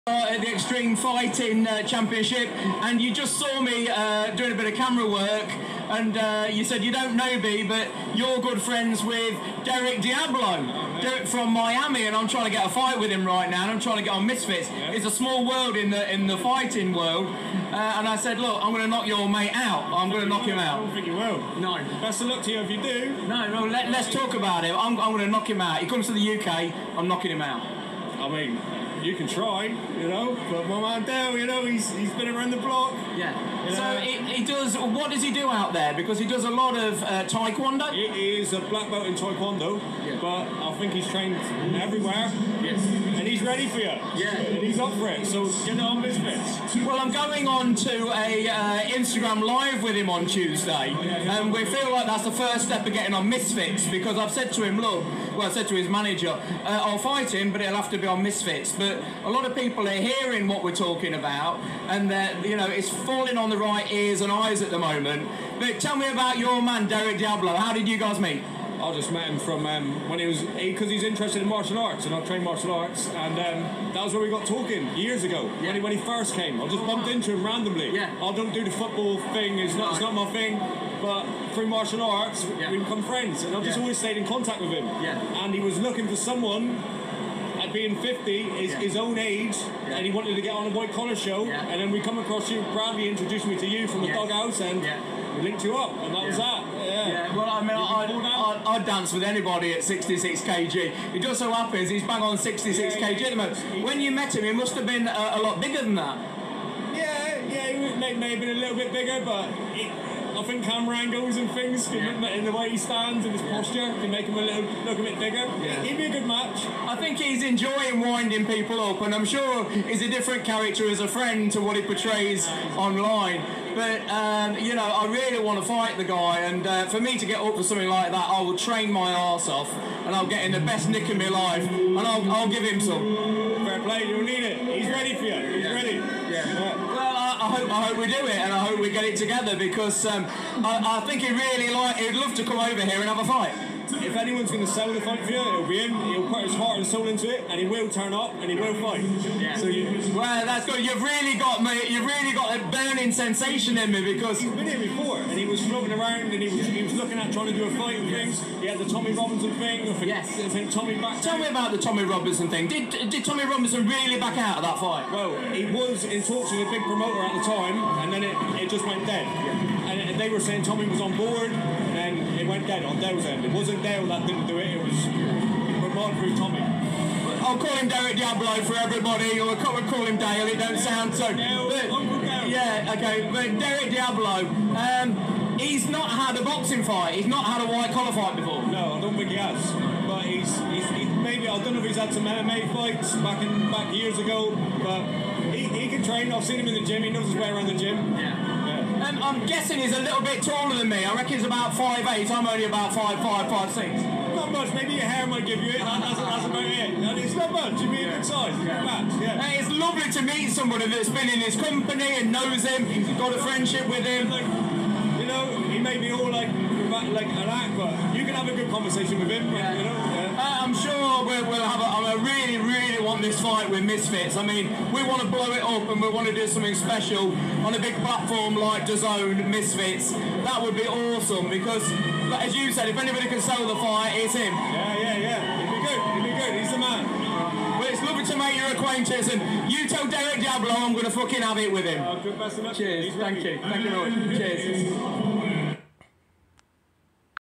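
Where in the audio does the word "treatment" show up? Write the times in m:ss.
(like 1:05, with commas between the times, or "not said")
not said.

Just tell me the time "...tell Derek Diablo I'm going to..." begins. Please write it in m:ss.
3:59.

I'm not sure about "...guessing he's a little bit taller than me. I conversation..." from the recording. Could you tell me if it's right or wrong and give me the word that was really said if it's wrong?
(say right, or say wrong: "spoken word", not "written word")
wrong: "reckon", not "conversation".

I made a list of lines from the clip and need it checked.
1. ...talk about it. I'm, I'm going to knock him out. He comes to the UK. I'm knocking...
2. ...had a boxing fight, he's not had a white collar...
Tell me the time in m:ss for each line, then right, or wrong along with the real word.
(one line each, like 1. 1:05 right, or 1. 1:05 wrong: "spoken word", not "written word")
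1. 0:24 right
2. 3:06 right.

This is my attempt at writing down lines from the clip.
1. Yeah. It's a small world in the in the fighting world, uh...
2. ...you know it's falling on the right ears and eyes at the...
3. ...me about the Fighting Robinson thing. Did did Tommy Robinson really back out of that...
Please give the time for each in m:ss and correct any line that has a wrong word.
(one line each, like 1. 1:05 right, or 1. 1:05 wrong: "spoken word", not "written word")
1. 0:14 right
2. 1:02 right
3. 2:41 wrong: "Tommy", not "Fighting".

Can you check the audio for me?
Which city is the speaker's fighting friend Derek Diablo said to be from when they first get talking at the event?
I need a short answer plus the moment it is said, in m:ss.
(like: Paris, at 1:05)
Miami, at 0:11.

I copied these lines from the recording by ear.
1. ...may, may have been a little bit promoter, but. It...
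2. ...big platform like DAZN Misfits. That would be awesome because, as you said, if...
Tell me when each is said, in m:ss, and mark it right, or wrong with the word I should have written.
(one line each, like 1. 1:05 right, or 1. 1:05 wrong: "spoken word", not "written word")
1. 1:47 wrong: "bigger", not "promoter"
2. 3:47 right.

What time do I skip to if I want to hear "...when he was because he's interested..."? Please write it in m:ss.
1:10.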